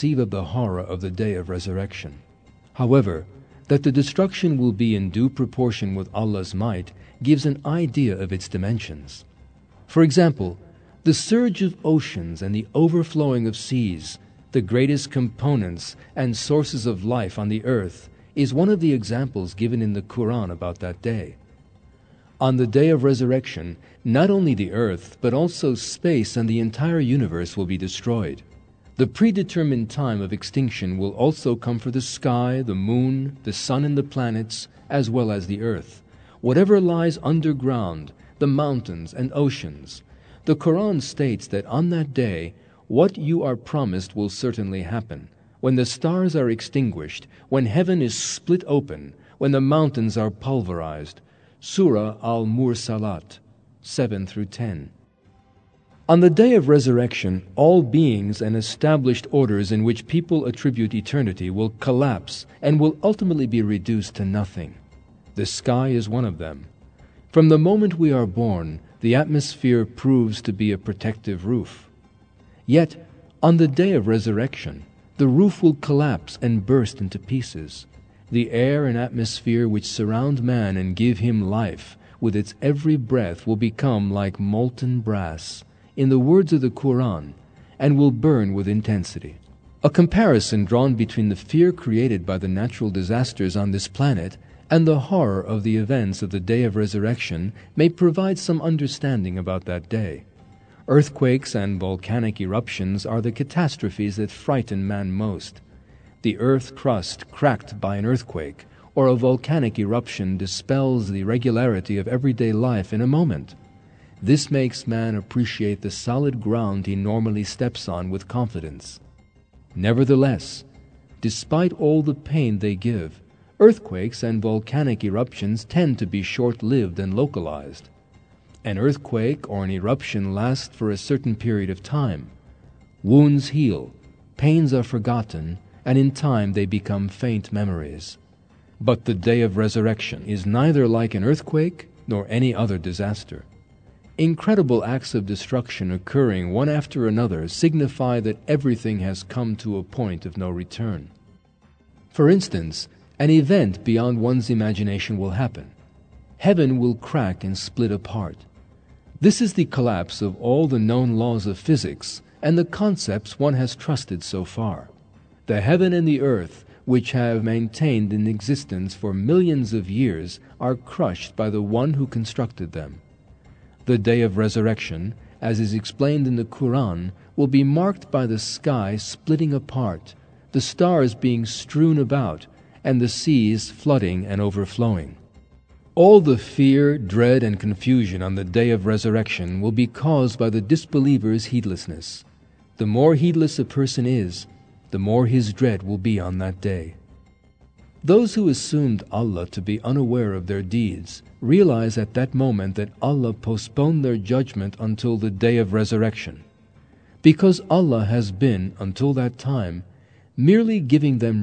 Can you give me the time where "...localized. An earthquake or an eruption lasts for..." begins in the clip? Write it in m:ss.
2:07.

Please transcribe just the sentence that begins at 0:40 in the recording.
The Quran states that on that day what you are promised will certainly happen.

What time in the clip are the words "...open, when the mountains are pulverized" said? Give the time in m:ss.
0:48.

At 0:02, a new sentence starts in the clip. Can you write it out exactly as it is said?
However, that the destruction will be in due proportion with Allah's might gives an idea of its dimensions.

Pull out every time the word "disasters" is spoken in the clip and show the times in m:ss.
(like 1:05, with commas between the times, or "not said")
1:32, 2:22.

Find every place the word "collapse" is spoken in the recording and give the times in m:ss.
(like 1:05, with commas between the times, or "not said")
1:01, 1:15, 2:39.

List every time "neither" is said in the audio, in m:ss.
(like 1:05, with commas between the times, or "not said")
2:20.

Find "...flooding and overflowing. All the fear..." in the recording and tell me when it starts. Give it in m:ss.
3:03.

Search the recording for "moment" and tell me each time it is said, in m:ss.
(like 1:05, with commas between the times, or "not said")
1:07, 1:53, 3:22.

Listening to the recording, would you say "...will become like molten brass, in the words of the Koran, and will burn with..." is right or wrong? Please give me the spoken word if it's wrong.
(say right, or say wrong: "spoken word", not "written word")
wrong: "Quran", not "Koran".